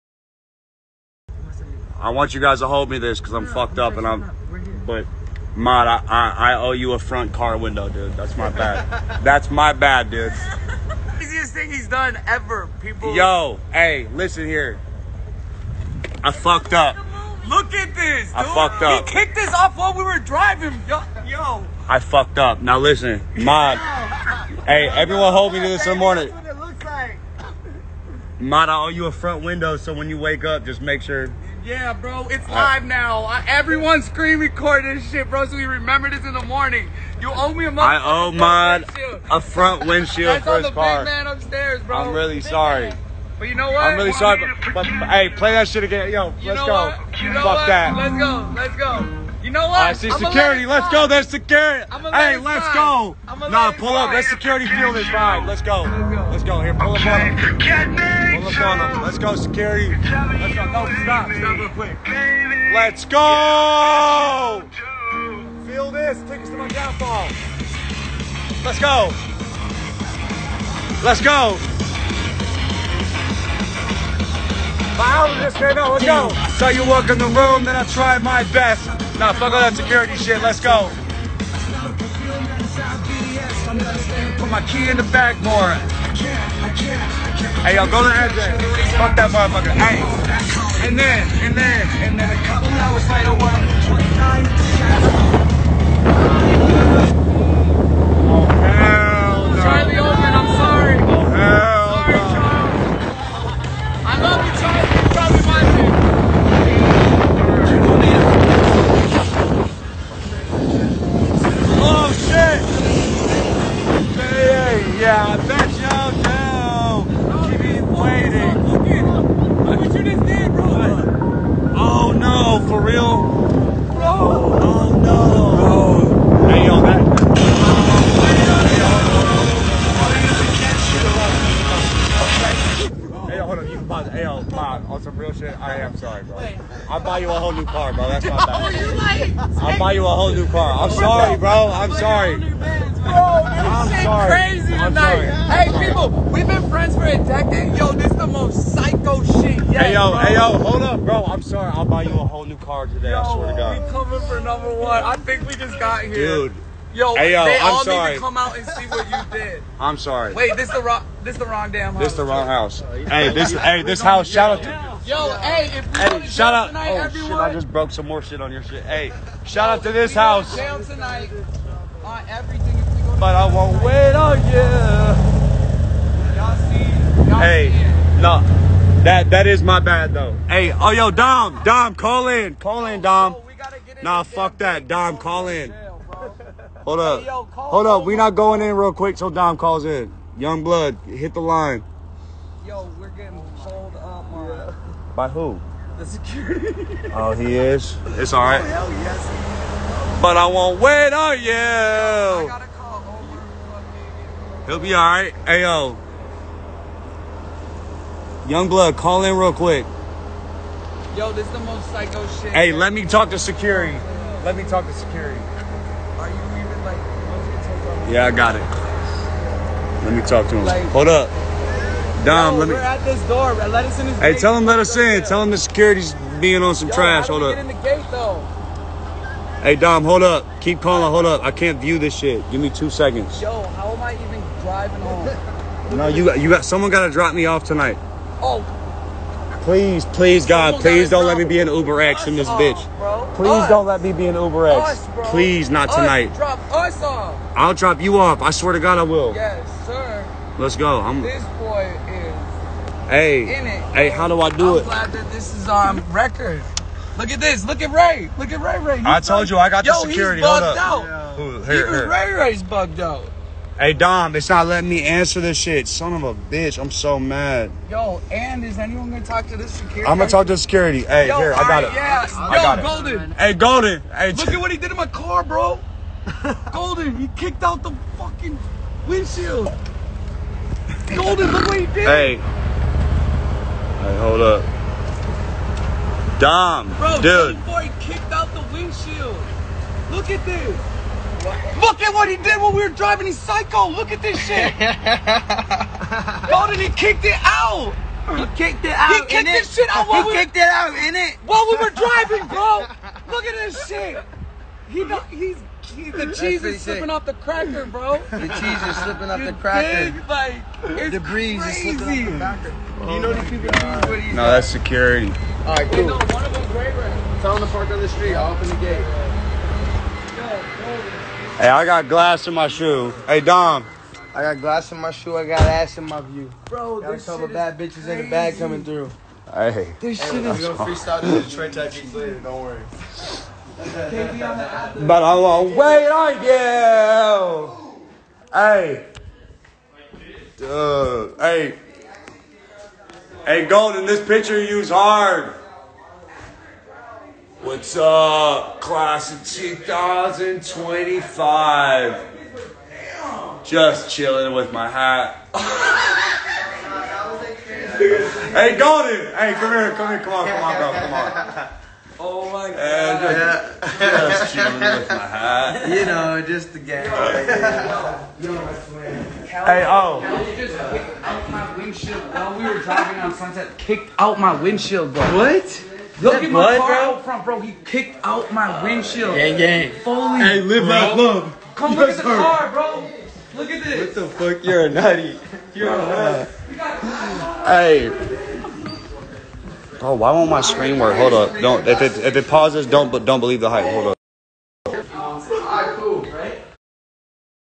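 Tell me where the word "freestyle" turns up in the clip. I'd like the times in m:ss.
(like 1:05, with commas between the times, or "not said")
5:30.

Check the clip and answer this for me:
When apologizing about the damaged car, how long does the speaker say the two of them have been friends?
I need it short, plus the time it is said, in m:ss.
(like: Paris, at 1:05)
a decade, at 2:27.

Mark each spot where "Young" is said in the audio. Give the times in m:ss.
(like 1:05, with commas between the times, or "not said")
3:10, 3:28.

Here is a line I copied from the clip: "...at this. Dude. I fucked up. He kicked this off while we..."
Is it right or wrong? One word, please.
right.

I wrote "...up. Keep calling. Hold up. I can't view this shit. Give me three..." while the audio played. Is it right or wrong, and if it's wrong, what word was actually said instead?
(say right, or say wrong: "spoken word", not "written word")
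wrong: "two", not "three".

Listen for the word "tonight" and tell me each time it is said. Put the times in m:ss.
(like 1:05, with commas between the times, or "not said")
2:24, 2:46, 2:50, 3:57, 4:05.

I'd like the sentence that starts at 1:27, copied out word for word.
Hey, y'all go to the address.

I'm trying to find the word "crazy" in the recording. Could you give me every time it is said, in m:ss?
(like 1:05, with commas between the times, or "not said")
2:24, 5:11, 5:28.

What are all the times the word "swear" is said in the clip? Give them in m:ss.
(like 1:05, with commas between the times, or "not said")
2:33, 4:08.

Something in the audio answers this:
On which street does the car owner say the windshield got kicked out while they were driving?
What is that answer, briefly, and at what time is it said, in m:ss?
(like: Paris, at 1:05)
Sunset, at 6:13.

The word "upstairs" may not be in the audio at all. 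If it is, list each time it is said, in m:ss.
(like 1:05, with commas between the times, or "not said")
0:41.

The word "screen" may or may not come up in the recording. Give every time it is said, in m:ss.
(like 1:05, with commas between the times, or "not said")
0:34, 6:30.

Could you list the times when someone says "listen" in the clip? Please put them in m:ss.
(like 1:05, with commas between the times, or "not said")
0:14, 0:22.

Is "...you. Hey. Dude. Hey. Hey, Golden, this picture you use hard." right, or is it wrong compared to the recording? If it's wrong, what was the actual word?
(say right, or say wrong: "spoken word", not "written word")
right.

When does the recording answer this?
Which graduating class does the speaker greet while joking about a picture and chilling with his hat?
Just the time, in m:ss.
5:48.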